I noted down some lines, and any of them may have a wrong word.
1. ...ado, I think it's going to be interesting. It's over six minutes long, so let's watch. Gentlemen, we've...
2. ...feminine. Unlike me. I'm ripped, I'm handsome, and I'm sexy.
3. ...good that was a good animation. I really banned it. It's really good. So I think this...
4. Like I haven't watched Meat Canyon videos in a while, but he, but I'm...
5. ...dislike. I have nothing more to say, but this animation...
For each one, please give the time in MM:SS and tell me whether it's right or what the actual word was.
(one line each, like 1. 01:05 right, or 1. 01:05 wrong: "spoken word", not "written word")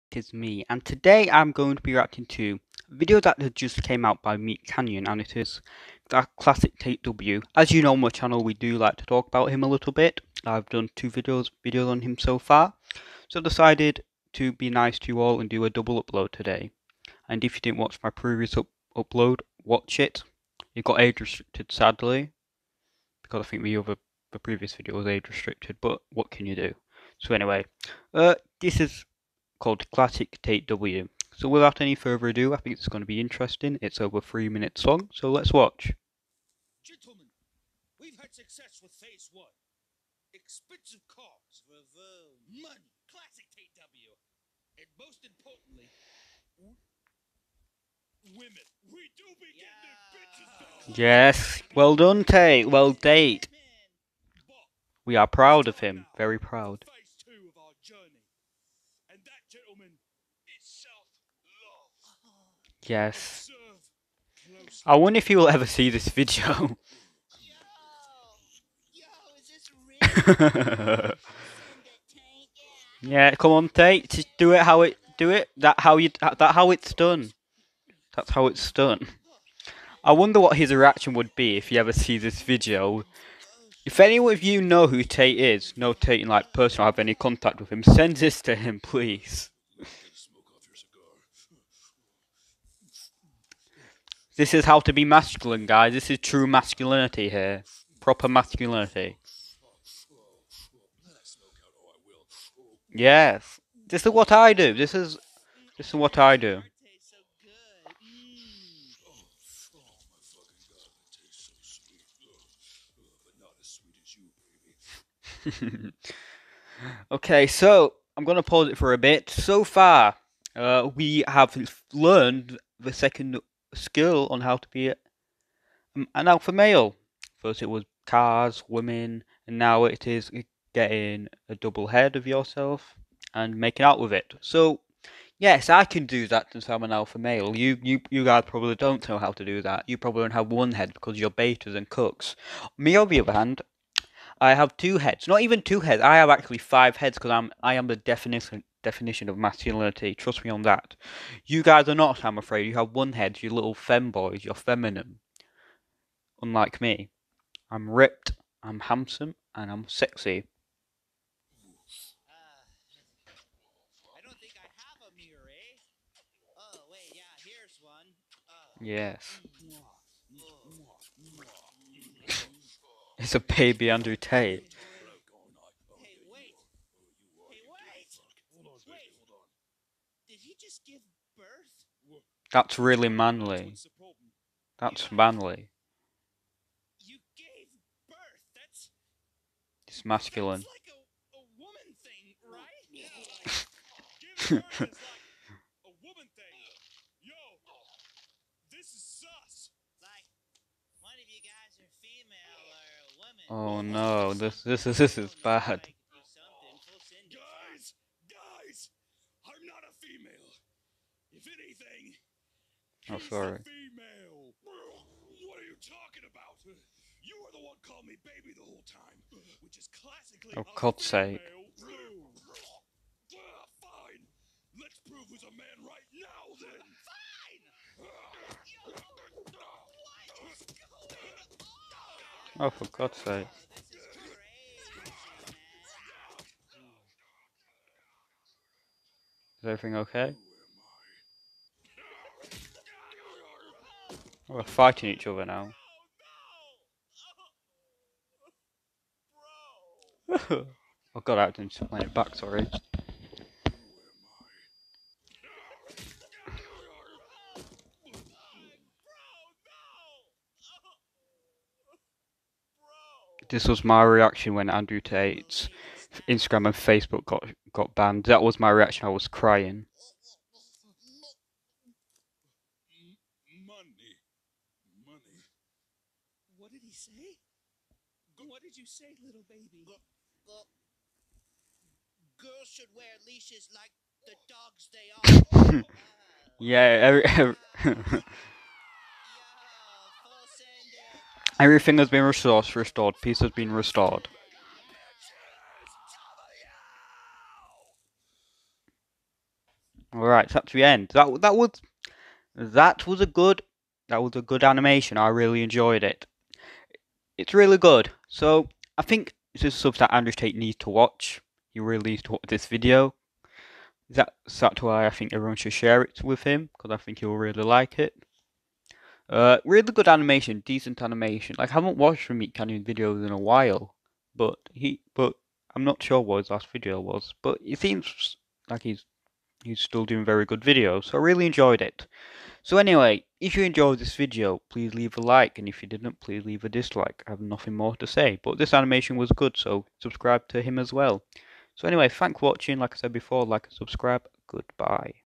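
1. 00:32 wrong: "three", not "six"
2. 02:34 right
3. 05:03 wrong: "enjoyed", not "banned"
4. 05:21 right
5. 05:36 right.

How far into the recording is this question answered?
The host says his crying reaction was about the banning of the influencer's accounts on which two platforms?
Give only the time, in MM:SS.
04:26.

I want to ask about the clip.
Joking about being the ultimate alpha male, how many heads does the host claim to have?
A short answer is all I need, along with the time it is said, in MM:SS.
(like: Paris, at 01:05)
5, at 02:26.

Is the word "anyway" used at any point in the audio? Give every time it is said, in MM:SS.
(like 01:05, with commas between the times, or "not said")
00:27, 05:32, 05:41.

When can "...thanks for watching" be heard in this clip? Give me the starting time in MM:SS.
05:42.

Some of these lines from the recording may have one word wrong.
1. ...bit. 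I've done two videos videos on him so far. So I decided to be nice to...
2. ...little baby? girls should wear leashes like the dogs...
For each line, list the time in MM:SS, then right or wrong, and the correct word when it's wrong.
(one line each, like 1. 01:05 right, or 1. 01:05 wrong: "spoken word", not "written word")
1. 00:09 right
2. 04:39 right.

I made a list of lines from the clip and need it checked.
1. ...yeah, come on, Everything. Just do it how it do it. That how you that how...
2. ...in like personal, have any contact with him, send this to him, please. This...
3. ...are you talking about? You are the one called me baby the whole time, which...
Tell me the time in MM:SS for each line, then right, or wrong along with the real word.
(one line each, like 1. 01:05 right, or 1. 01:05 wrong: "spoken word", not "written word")
1. 01:13 wrong: "Tate", not "Everything"
2. 01:26 right
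3. 03:35 right.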